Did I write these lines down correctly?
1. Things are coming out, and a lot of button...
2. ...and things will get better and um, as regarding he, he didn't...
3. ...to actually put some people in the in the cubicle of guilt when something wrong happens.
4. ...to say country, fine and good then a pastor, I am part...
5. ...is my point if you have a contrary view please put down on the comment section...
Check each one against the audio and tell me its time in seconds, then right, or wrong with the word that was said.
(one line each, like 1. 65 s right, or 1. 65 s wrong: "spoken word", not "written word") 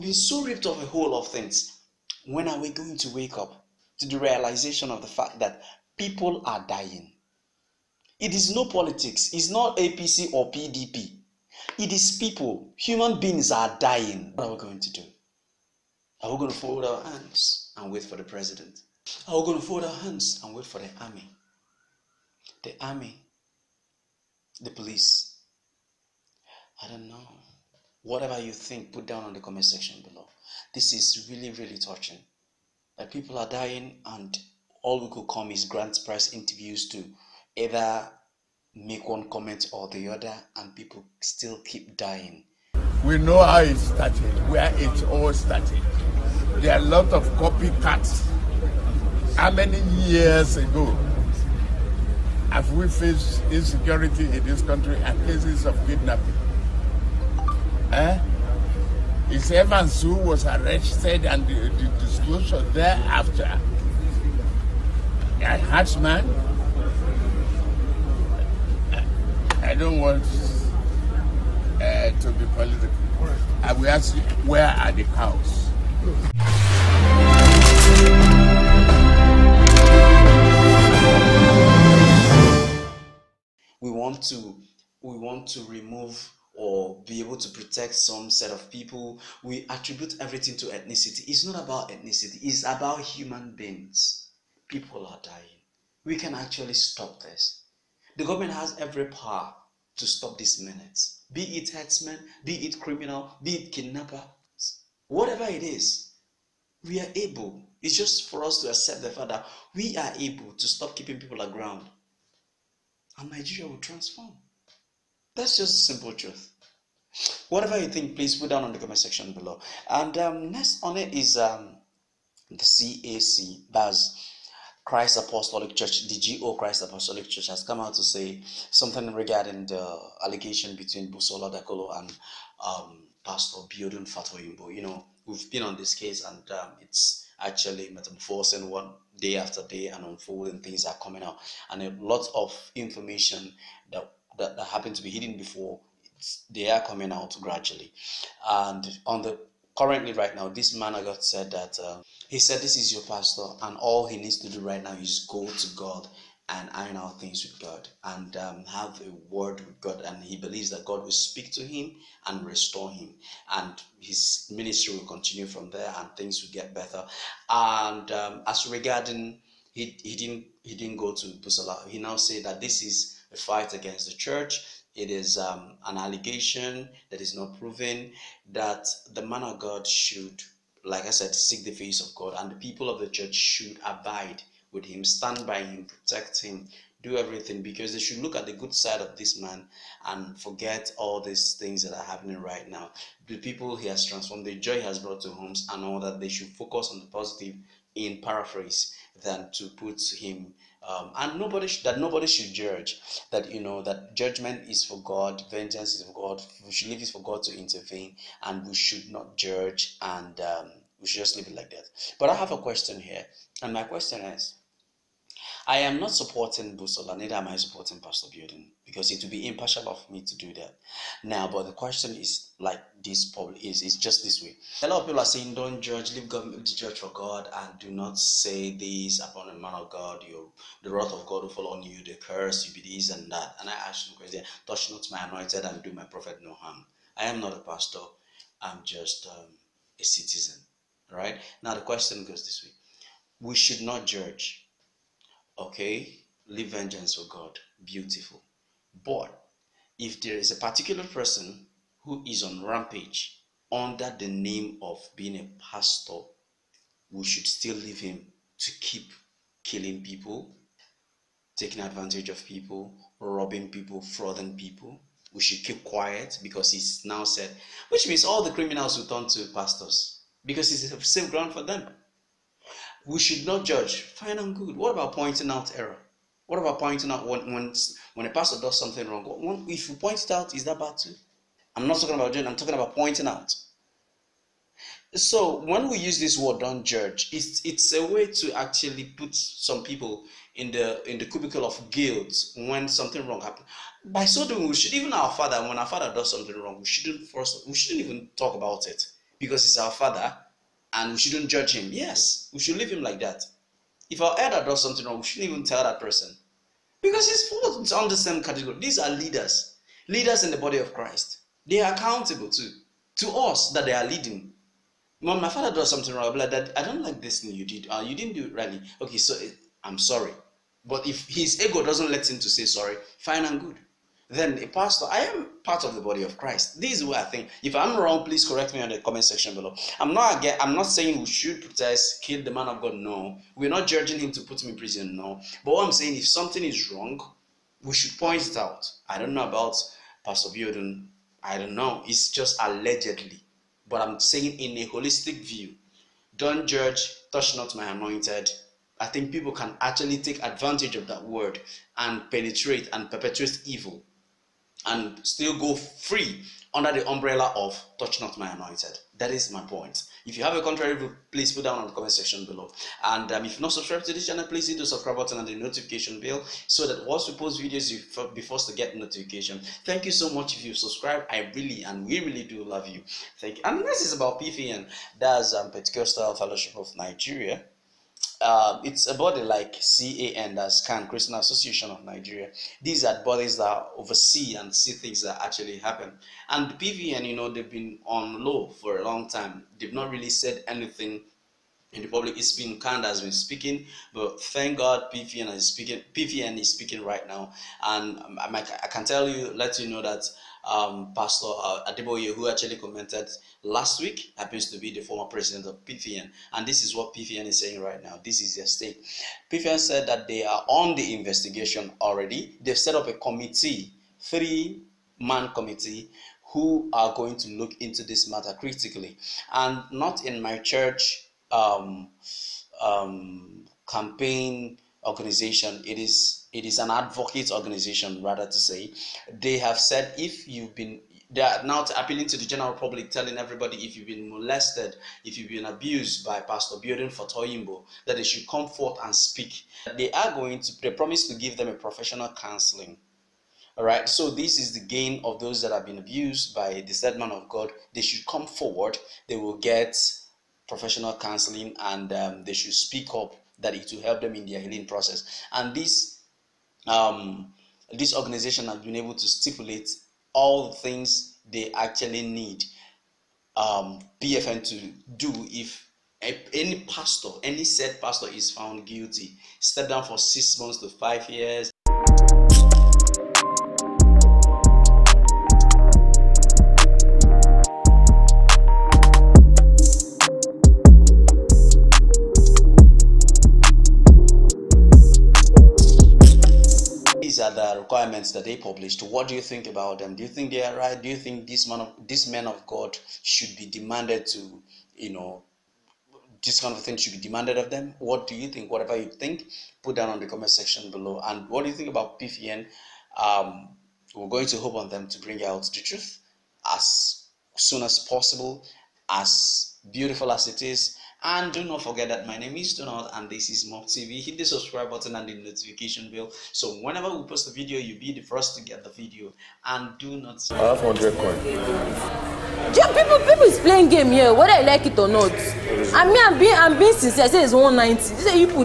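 1. 140 s wrong: "information", not "button"
2. 165 s right
3. 288 s right
4. 322 s wrong: "sorry", not "country"
5. 359 s right.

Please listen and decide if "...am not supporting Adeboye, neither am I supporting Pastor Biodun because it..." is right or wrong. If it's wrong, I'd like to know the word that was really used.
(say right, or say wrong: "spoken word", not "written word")
wrong: "Busola", not "Adeboye".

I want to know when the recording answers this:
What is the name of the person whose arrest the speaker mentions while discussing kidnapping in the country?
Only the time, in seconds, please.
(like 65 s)
59 s.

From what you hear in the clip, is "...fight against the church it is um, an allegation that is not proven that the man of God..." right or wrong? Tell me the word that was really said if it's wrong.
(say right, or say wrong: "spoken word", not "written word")
right.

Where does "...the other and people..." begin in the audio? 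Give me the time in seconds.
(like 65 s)
39 s.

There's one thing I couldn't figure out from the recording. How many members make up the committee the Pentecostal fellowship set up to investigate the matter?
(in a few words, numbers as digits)
3.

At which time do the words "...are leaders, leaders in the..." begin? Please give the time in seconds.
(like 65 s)
308 s.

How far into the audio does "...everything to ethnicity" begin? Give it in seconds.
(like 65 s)
90 s.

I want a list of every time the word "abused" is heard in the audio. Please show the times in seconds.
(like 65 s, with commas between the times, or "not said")
435 s, 445 s.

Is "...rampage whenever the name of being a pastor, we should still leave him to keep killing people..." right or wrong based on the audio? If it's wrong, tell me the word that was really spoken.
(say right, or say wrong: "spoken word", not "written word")
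wrong: "under", not "whenever".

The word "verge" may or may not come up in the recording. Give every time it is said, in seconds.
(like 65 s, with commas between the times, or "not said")
not said.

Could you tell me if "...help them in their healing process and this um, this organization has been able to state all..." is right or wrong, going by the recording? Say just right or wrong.
wrong.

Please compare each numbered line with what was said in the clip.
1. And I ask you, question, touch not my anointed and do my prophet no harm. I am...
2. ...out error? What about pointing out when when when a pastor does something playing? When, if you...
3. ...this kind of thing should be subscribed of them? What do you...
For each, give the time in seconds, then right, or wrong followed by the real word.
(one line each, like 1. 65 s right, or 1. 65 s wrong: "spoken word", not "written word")
1. 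233 s right
2. 275 s wrong: "wrong", not "playing"
3. 496 s wrong: "demanded", not "subscribed".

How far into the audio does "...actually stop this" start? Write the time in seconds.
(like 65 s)
96 s.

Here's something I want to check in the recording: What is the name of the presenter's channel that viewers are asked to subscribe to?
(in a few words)
Mob TV.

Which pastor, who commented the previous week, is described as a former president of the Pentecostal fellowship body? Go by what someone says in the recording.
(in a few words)
Adeboye.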